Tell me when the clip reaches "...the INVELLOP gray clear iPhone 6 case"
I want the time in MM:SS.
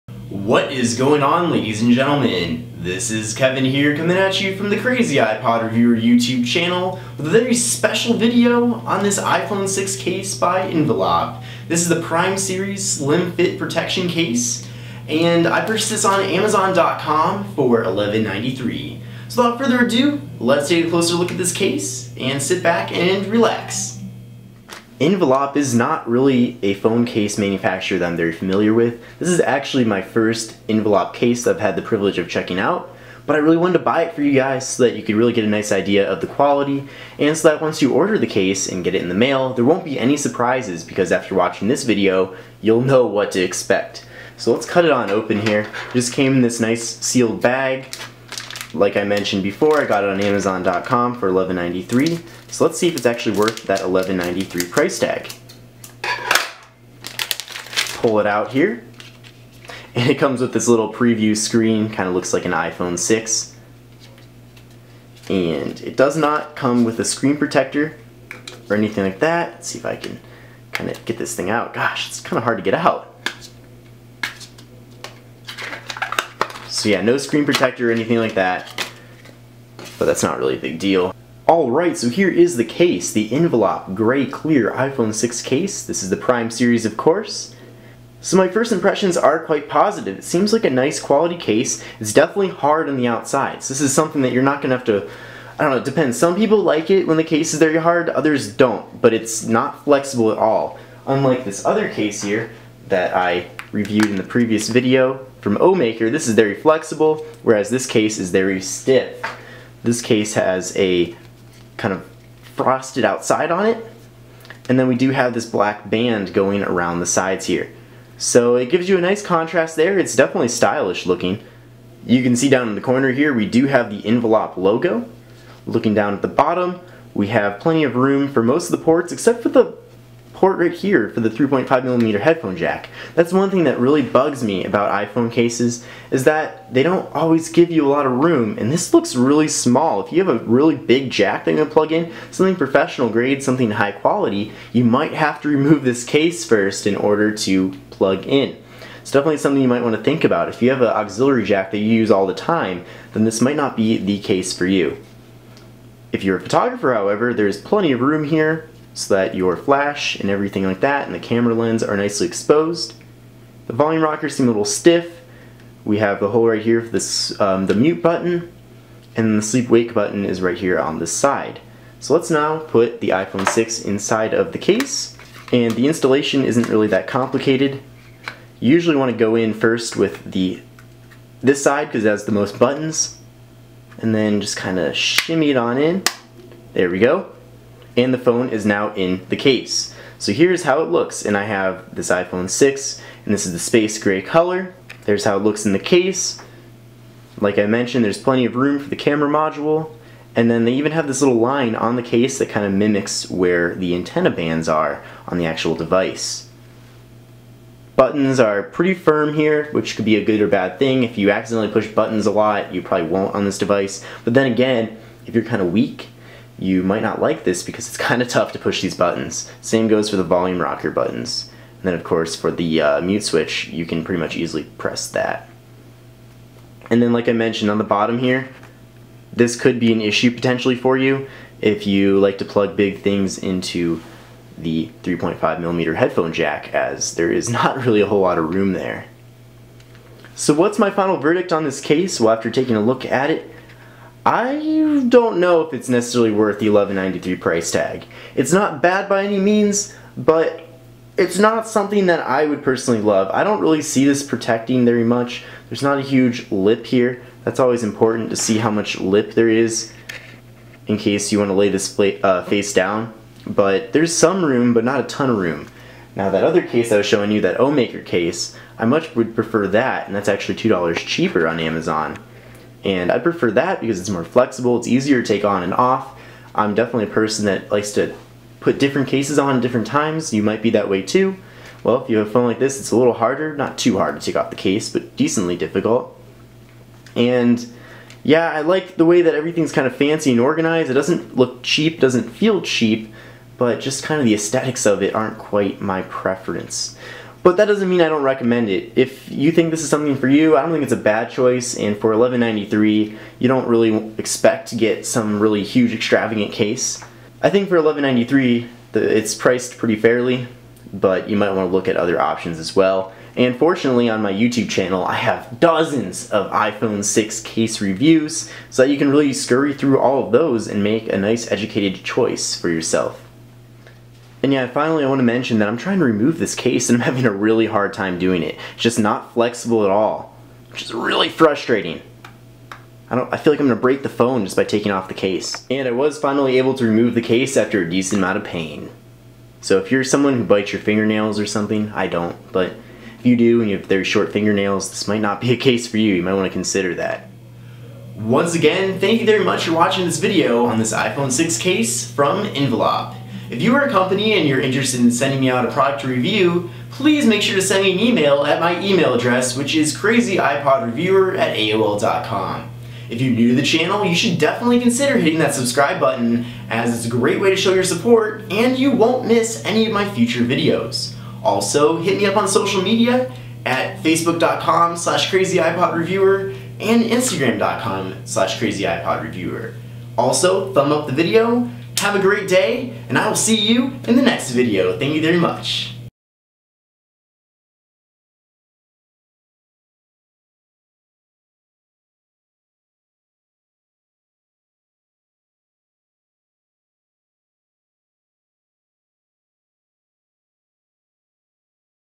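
01:23.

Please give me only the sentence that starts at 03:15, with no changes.
There's how it looks in the case.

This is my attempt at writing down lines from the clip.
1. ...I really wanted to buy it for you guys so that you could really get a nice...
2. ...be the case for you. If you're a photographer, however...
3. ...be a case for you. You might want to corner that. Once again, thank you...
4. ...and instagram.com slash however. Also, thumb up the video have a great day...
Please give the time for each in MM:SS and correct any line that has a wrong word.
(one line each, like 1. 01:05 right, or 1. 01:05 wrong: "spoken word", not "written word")
1. 00:33 right
2. 02:33 right
3. 05:45 wrong: "consider", not "corner"
4. 06:16 wrong: "crazyipodreviewer", not "however".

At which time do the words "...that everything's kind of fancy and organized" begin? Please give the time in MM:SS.
04:49.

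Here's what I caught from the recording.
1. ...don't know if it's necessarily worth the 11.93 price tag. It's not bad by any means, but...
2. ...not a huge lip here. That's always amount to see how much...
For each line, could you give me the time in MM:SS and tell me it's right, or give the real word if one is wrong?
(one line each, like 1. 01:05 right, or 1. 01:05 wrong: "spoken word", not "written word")
1. 04:05 right
2. 04:15 wrong: "important", not "amount".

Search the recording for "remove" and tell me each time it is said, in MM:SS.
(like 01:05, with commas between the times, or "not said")
02:25, 05:26, 05:36.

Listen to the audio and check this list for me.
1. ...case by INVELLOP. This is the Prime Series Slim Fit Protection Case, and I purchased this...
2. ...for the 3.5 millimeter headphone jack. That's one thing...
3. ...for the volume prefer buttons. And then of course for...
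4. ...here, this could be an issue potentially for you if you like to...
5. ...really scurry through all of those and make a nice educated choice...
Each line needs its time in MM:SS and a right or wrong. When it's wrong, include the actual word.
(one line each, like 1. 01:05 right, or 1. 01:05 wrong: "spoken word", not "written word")
1. 00:09 right
2. 02:11 right
3. 03:40 wrong: "rocker", not "prefer"
4. 03:48 right
5. 05:19 right.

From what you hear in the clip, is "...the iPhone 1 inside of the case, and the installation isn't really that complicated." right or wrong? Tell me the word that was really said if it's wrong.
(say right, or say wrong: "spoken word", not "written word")
wrong: "6", not "1".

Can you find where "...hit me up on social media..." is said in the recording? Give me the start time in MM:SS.
06:12.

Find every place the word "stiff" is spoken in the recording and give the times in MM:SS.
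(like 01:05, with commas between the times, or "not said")
01:48, 02:44.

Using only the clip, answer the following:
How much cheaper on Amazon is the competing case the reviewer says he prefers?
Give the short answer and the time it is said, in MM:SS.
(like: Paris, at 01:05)
$2, at 04:30.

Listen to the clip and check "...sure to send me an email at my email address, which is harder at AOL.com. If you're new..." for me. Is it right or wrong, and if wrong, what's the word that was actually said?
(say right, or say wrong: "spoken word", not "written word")
wrong: "crazyipodreviewer", not "harder".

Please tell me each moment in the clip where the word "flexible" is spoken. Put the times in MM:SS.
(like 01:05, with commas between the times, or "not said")
01:39, 01:46, 04:34, 05:29.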